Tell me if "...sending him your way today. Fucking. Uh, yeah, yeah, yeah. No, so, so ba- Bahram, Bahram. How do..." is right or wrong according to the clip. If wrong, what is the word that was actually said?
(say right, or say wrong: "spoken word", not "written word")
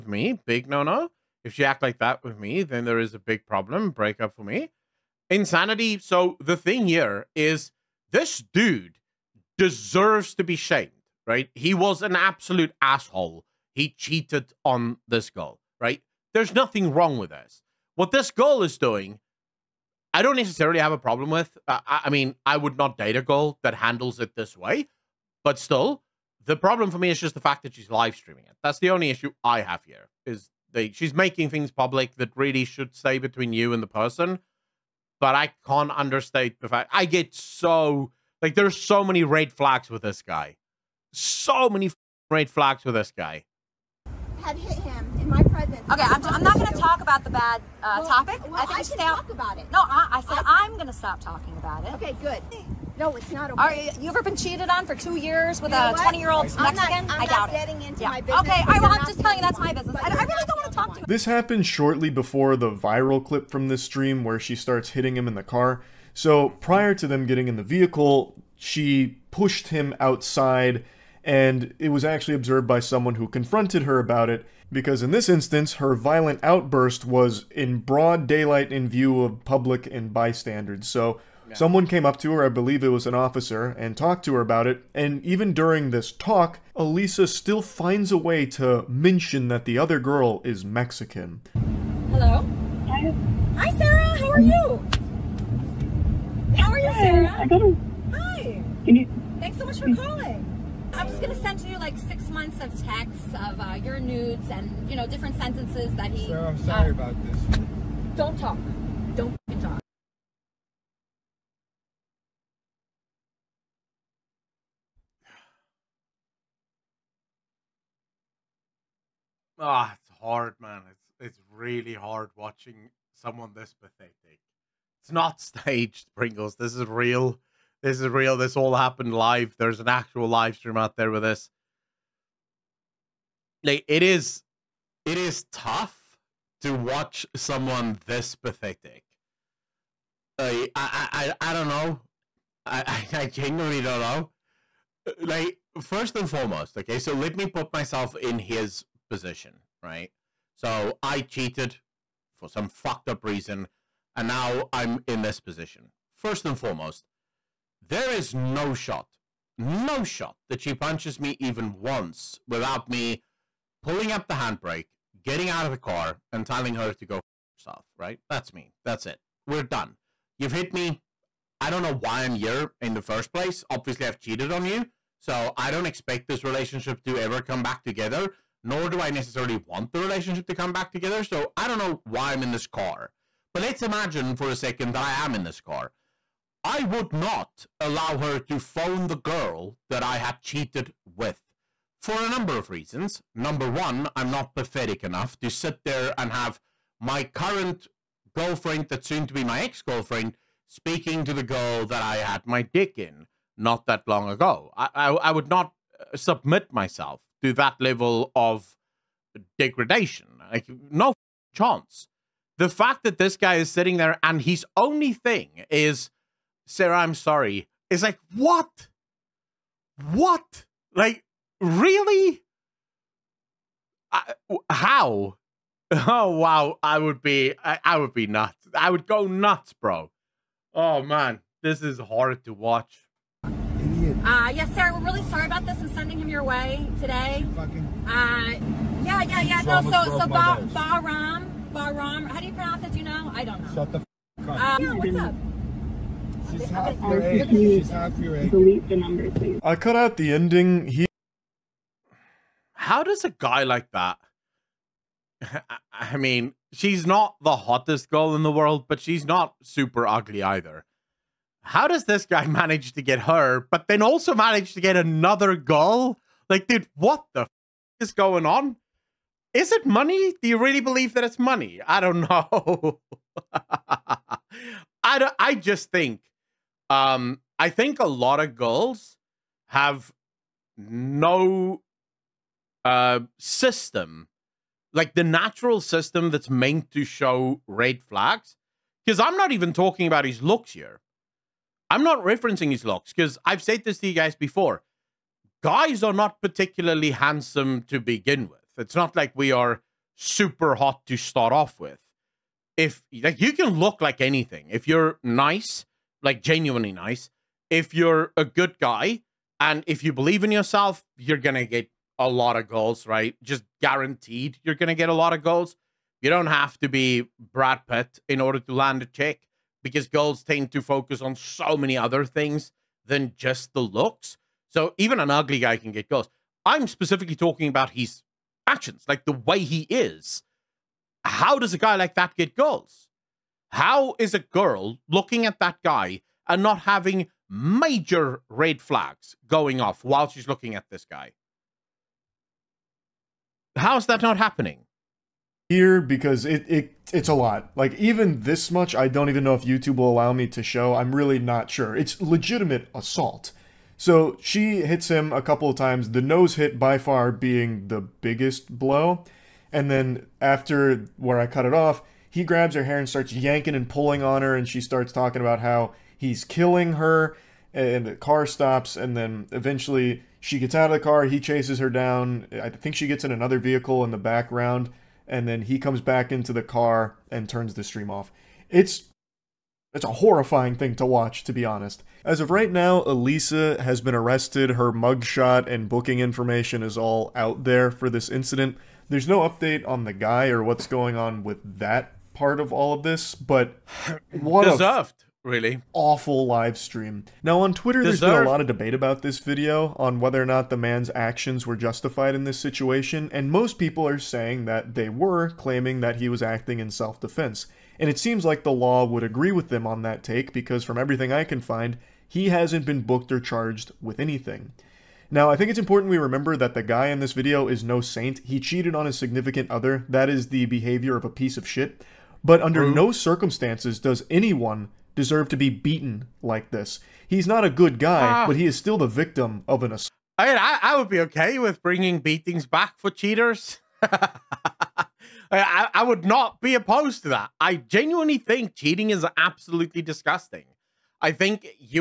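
right.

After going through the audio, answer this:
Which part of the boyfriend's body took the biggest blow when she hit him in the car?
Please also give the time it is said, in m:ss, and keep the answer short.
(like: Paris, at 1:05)
Nose, at 5:56.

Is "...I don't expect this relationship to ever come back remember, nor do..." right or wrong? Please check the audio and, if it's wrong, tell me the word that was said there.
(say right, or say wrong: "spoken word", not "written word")
wrong: "together", not "remember".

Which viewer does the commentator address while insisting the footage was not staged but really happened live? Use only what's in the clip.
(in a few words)
Pringles.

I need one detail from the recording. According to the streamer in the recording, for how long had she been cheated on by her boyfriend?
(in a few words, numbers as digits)
2 years.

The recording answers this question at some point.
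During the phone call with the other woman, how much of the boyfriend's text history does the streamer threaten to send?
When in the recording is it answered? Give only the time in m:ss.
1:41.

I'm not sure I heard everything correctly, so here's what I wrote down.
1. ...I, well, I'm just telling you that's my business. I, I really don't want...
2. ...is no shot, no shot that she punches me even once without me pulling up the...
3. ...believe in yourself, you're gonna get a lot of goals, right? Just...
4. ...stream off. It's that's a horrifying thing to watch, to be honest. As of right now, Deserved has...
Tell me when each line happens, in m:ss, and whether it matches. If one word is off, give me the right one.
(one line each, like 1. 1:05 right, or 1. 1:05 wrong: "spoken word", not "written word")
1. 0:58 right
2. 2:38 right
3. 5:10 right
4. 6:17 wrong: "Elisa", not "Deserved".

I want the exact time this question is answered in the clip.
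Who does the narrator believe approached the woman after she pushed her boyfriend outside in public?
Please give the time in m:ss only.
1:23.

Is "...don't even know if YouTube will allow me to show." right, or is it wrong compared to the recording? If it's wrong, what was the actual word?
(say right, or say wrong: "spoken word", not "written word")
right.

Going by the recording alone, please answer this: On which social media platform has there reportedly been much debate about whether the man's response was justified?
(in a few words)
Twitter.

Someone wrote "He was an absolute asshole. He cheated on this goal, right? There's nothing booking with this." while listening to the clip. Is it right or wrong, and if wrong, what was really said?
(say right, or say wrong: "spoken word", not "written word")
wrong: "wrong", not "booking".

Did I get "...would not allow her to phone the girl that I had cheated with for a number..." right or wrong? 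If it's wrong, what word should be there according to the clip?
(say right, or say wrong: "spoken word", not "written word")
right.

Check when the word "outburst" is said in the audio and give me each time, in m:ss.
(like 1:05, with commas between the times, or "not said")
1:16.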